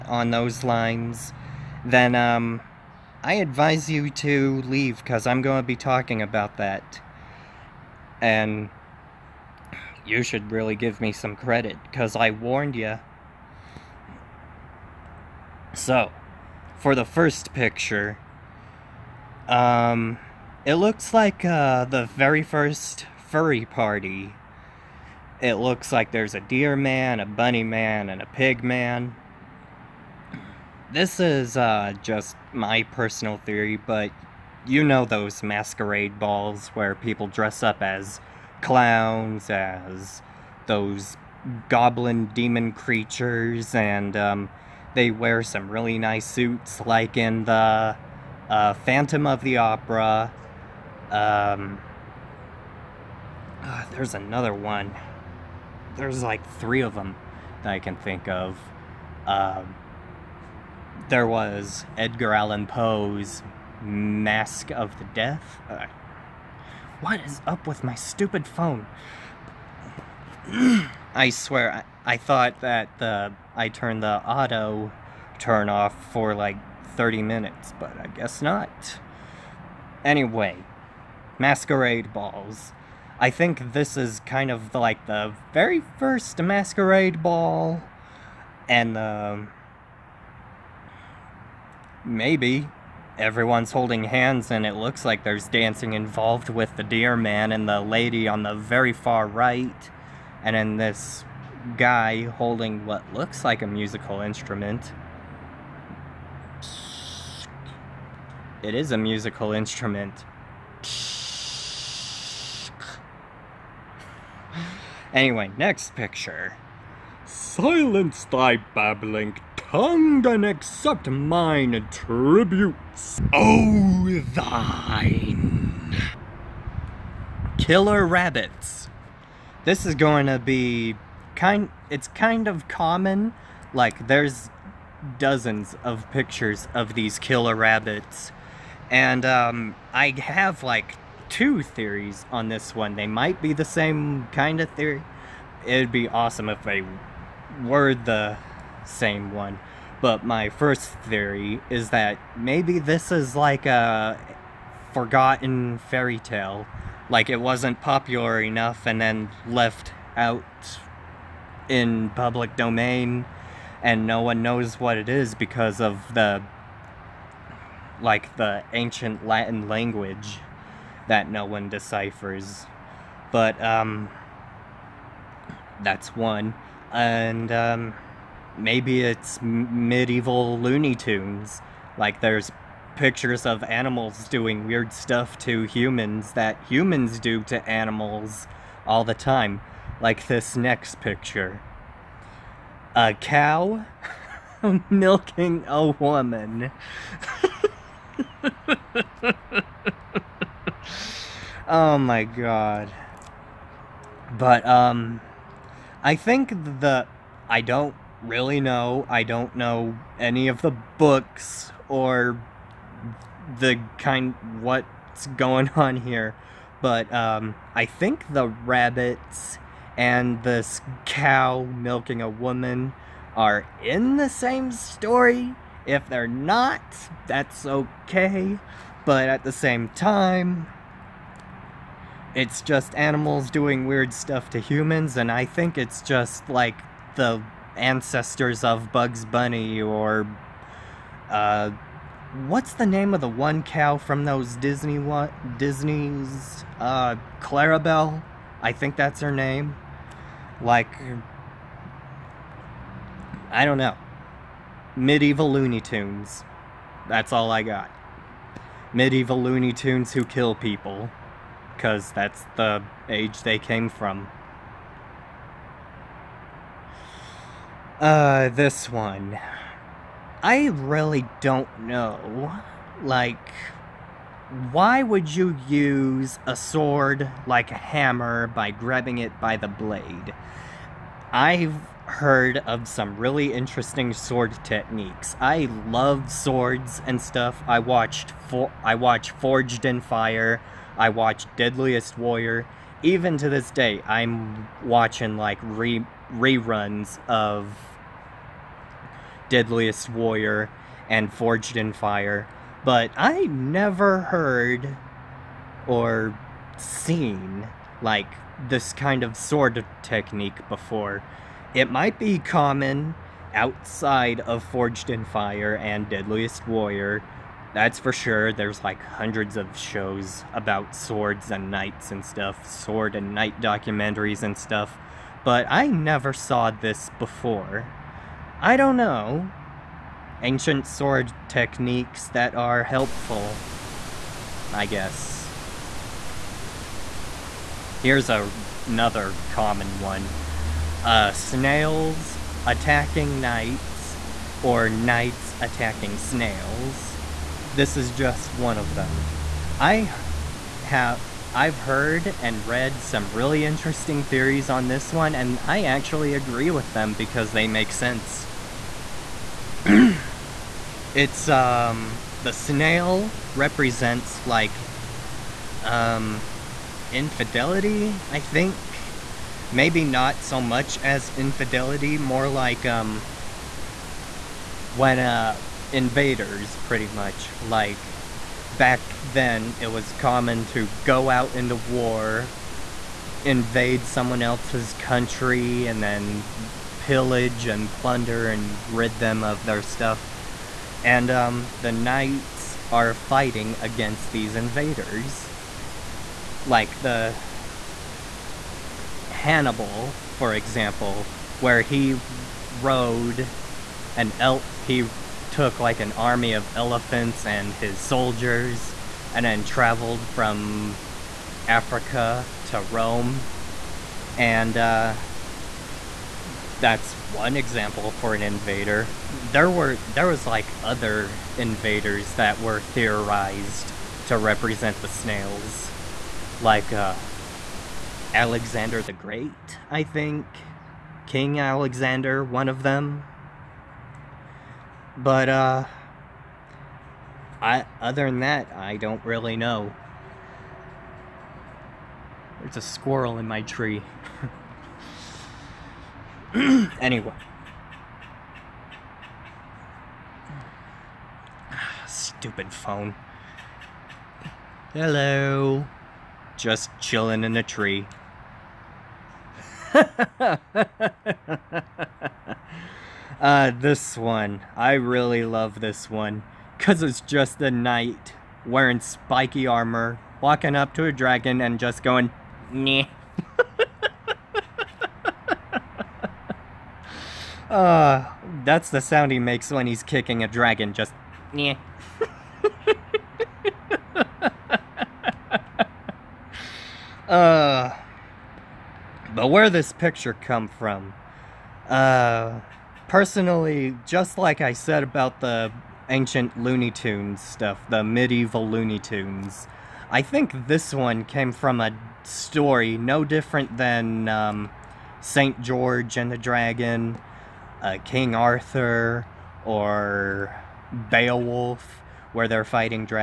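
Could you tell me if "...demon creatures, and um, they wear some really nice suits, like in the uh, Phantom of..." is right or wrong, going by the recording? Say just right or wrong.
right.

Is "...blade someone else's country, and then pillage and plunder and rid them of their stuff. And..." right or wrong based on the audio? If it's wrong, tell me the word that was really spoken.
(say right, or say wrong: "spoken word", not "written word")
wrong: "invade", not "blade".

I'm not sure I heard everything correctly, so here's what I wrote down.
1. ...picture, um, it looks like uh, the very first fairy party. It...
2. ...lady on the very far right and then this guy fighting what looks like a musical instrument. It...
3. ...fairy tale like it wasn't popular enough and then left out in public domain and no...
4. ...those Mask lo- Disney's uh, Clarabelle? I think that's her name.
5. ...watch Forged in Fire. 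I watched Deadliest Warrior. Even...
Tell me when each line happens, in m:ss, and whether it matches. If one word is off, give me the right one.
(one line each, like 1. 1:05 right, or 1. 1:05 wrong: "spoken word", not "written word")
1. 0:17 wrong: "furry", not "fairy"
2. 1:37 wrong: "holding", not "fighting"
3. 2:35 right
4. 4:04 wrong: "Disney", not "Mask"
5. 4:48 right.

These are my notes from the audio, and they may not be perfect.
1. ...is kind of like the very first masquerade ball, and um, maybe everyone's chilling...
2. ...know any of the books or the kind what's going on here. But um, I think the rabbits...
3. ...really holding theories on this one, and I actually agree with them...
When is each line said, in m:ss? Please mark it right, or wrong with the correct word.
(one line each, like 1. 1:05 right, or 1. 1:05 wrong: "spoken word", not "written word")
1. 1:23 wrong: "holding", not "chilling"
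2. 3:29 right
3. 5:53 wrong: "interesting", not "holding".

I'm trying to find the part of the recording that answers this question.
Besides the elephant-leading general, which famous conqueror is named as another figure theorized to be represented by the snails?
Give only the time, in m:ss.
7:08.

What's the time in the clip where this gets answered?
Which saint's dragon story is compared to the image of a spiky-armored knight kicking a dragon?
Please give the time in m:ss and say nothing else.
8:25.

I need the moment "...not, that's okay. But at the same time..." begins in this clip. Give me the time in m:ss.
3:46.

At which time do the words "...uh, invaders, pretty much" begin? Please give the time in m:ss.
6:15.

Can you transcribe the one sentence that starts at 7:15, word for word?
But, uh, I, other than that, I don't really know.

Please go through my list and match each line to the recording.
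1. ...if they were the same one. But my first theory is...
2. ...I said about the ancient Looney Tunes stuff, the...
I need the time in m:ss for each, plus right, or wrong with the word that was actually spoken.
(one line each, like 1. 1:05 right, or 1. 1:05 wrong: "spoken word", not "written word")
1. 2:26 right
2. 8:14 right.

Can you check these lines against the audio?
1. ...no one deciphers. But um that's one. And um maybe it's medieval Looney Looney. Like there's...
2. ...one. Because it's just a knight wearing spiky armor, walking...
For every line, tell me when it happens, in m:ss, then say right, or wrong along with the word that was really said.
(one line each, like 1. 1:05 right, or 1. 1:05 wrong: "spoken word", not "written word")
1. 2:51 wrong: "Tunes", not "Looney"
2. 7:46 right.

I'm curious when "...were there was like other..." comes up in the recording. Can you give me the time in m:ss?
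6:59.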